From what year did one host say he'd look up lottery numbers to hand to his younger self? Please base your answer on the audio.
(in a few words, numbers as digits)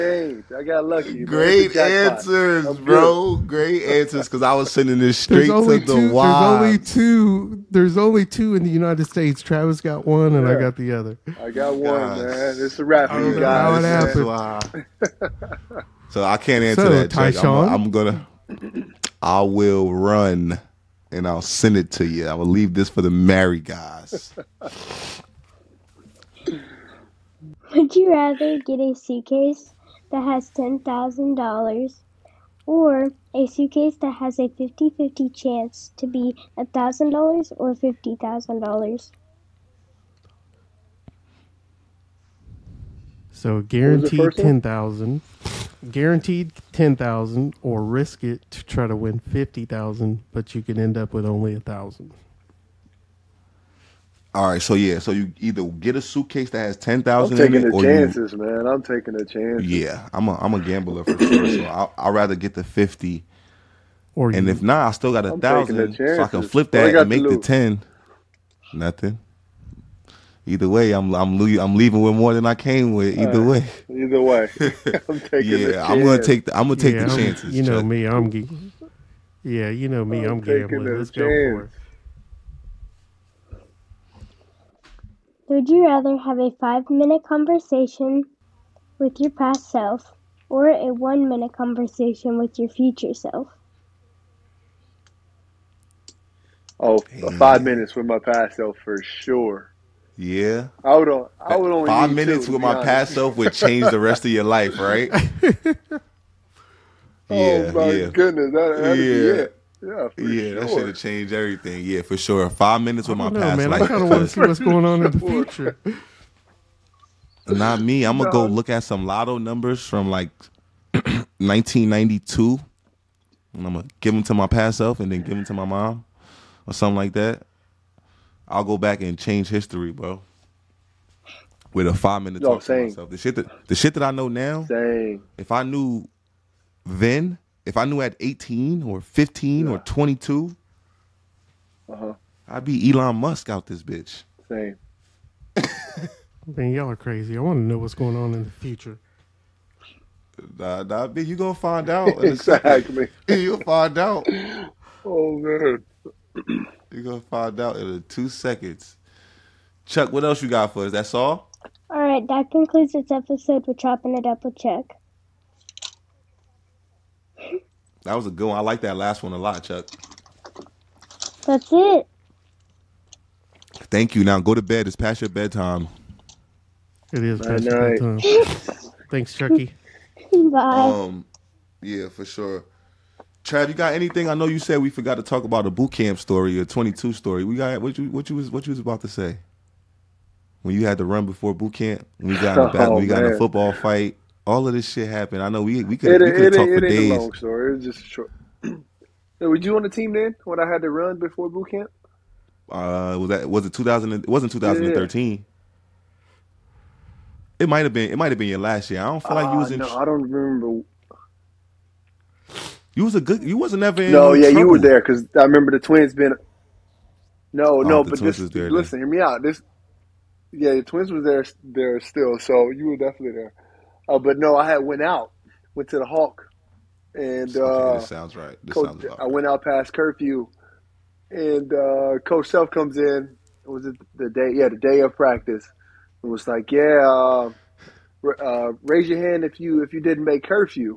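1992.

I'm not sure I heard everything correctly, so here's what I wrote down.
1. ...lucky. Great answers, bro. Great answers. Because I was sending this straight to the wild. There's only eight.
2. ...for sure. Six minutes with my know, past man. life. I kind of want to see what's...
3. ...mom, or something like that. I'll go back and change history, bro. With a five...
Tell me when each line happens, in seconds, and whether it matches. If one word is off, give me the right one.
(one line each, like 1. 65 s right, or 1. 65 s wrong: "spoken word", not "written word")
1. 0 s wrong: "two", not "eight"
2. 112 s wrong: "Five", not "Six"
3. 125 s right.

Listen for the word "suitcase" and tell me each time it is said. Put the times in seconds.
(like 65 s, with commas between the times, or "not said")
28 s, 33 s, 56 s.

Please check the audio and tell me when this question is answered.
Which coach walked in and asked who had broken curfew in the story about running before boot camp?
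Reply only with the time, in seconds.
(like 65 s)
232 s.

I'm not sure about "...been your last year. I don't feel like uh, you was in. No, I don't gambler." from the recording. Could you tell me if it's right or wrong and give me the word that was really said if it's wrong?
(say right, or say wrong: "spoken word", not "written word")
wrong: "remember", not "gambler".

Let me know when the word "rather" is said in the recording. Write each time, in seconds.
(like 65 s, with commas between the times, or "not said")
28 s, 62 s, 85 s.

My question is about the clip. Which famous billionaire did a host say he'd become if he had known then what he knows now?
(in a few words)
Elon Musk.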